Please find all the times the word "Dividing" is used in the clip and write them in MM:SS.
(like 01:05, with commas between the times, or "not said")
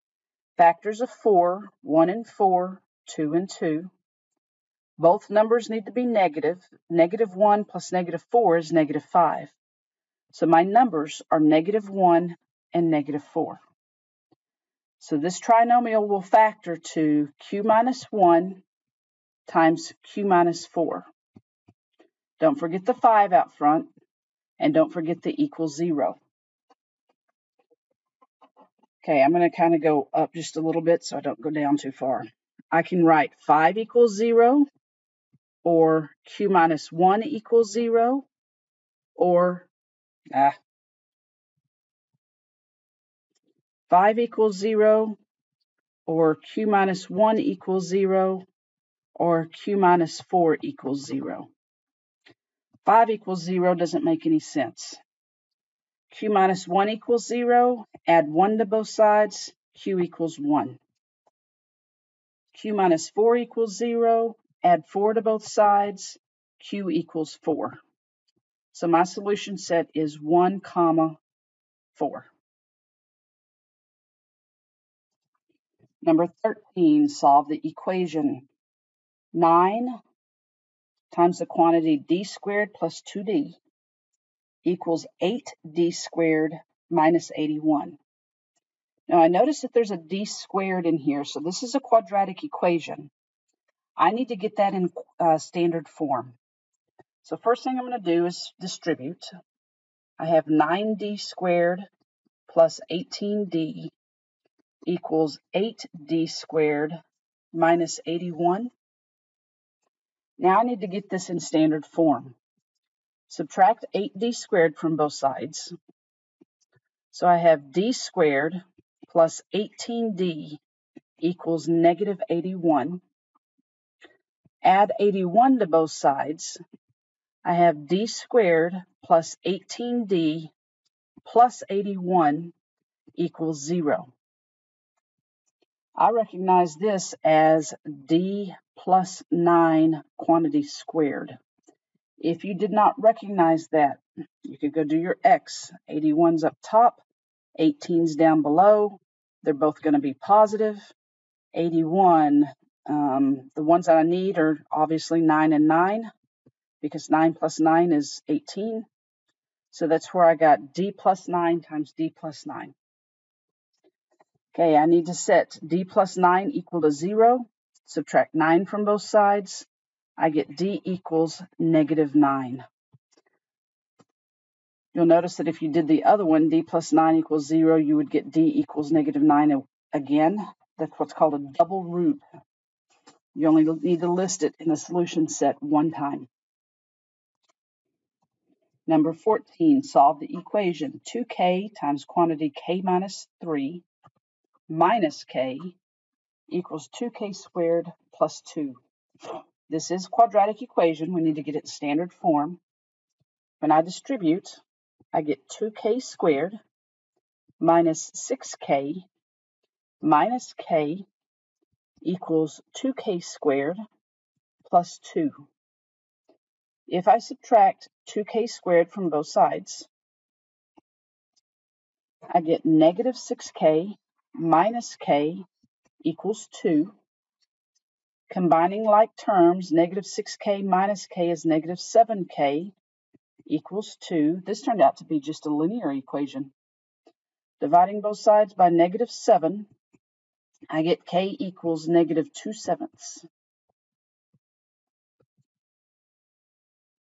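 03:57.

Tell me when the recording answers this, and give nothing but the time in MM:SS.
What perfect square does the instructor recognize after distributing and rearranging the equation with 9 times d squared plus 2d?
02:18.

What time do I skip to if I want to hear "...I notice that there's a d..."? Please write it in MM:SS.
01:29.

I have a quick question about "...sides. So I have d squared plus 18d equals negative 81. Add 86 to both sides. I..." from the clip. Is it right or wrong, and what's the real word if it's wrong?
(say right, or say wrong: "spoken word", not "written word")
wrong: "81", not "86".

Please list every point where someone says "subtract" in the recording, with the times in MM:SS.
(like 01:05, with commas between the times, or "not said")
01:53, 02:47, 03:37.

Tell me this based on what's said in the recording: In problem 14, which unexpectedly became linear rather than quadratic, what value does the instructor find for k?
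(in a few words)
-2/7.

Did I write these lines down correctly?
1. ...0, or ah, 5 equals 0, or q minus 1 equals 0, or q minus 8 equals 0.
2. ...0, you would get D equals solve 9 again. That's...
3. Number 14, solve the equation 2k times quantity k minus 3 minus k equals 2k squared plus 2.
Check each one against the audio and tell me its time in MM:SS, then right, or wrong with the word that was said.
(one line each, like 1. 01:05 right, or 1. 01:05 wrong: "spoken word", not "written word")
1. 00:37 wrong: "4", not "8"
2. 02:57 wrong: "negative", not "solve"
3. 03:08 right.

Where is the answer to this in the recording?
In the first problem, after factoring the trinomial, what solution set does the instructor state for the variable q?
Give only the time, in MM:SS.
01:10.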